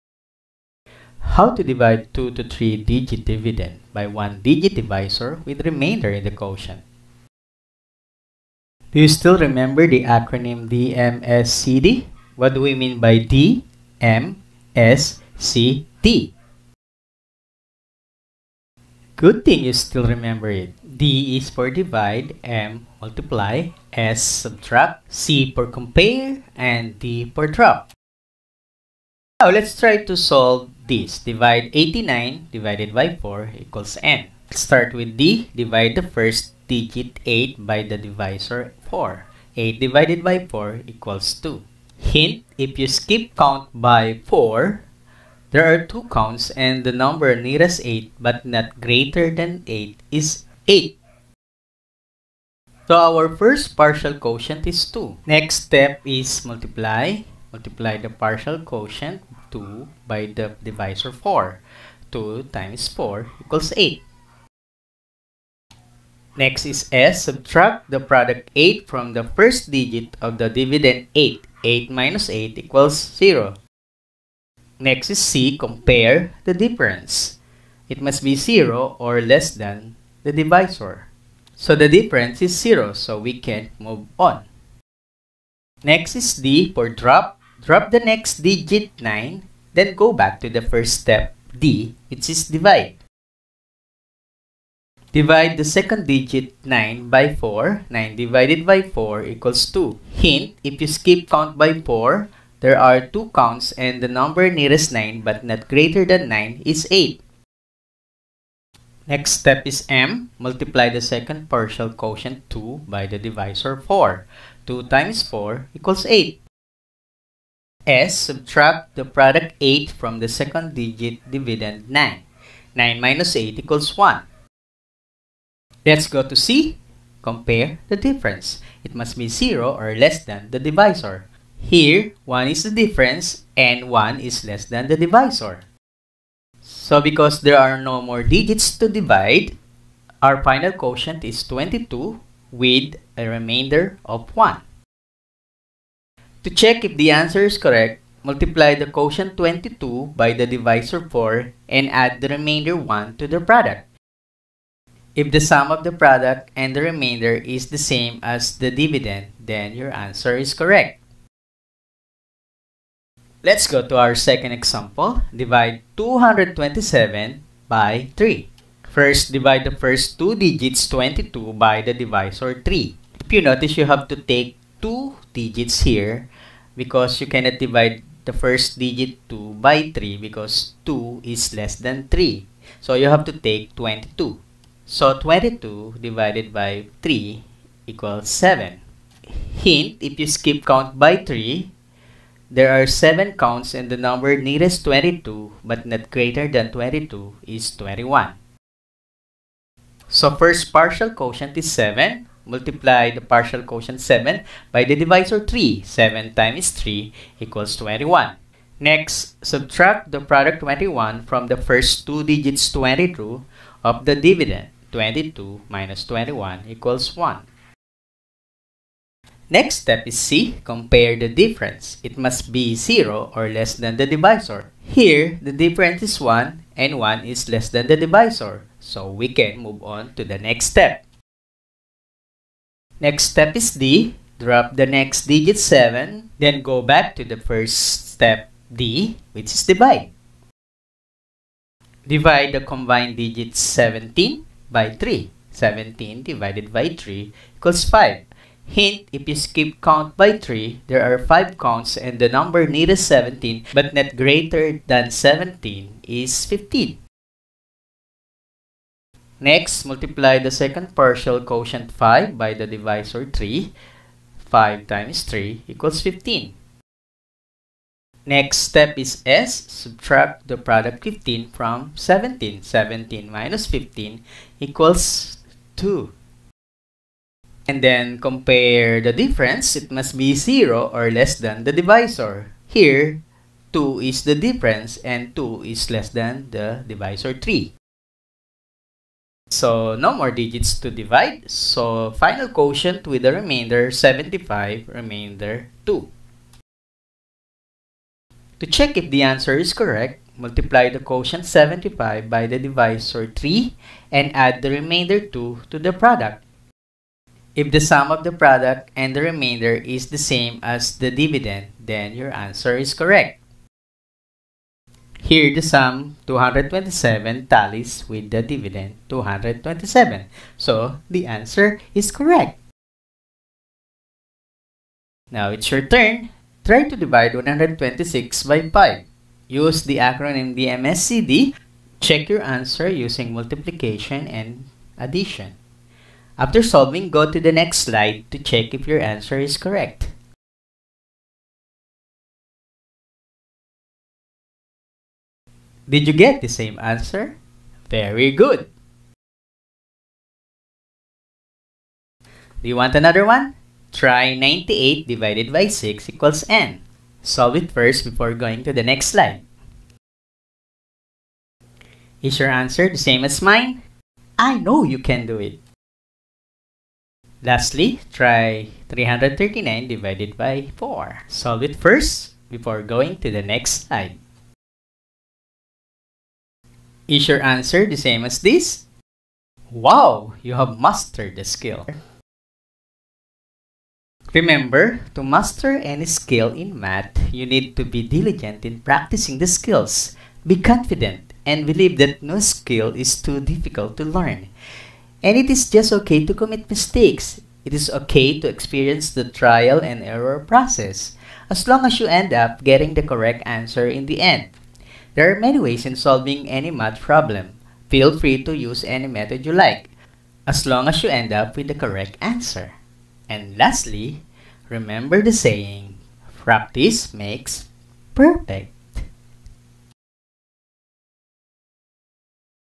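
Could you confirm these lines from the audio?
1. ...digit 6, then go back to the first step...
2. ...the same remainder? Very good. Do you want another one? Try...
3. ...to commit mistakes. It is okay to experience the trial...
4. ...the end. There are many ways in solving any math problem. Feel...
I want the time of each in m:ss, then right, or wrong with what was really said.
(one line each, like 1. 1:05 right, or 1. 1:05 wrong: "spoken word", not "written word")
1. 1:28 wrong: "9", not "6"
2. 5:46 wrong: "answer", not "remainder"
3. 6:36 right
4. 6:44 right.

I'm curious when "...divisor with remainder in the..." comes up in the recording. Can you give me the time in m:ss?
0:04.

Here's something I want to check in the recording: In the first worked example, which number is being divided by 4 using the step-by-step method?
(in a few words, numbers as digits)
89.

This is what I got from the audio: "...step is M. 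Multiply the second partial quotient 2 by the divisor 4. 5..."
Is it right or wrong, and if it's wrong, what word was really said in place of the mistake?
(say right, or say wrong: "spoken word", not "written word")
wrong: "2", not "5".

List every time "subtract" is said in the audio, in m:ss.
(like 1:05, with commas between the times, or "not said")
0:24, 1:07, 1:58, 3:29, 4:29.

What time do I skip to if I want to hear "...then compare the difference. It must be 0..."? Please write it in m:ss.
4:37.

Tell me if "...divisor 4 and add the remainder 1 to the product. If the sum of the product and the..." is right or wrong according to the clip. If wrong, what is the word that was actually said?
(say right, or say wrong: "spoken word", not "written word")
right.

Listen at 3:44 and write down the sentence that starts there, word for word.
Here, the difference is 1 and 1 is less than the divisor.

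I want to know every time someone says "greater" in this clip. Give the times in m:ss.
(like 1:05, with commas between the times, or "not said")
0:48, 1:45, 3:16, 4:14.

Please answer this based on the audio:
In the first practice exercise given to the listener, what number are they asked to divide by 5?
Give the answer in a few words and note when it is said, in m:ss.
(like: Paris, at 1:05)
126, at 5:27.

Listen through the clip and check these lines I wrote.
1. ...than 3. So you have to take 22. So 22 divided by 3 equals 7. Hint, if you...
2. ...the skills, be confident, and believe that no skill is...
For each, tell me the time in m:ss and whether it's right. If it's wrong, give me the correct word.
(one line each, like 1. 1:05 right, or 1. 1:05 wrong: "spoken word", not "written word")
1. 3:01 right
2. 6:29 right.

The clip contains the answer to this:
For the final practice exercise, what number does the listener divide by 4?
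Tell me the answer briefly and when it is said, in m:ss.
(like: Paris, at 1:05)
339, at 6:08.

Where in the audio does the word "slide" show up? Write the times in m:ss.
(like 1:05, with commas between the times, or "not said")
5:37, 5:59, 6:13.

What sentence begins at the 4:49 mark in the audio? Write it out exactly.
So no more digits to divide.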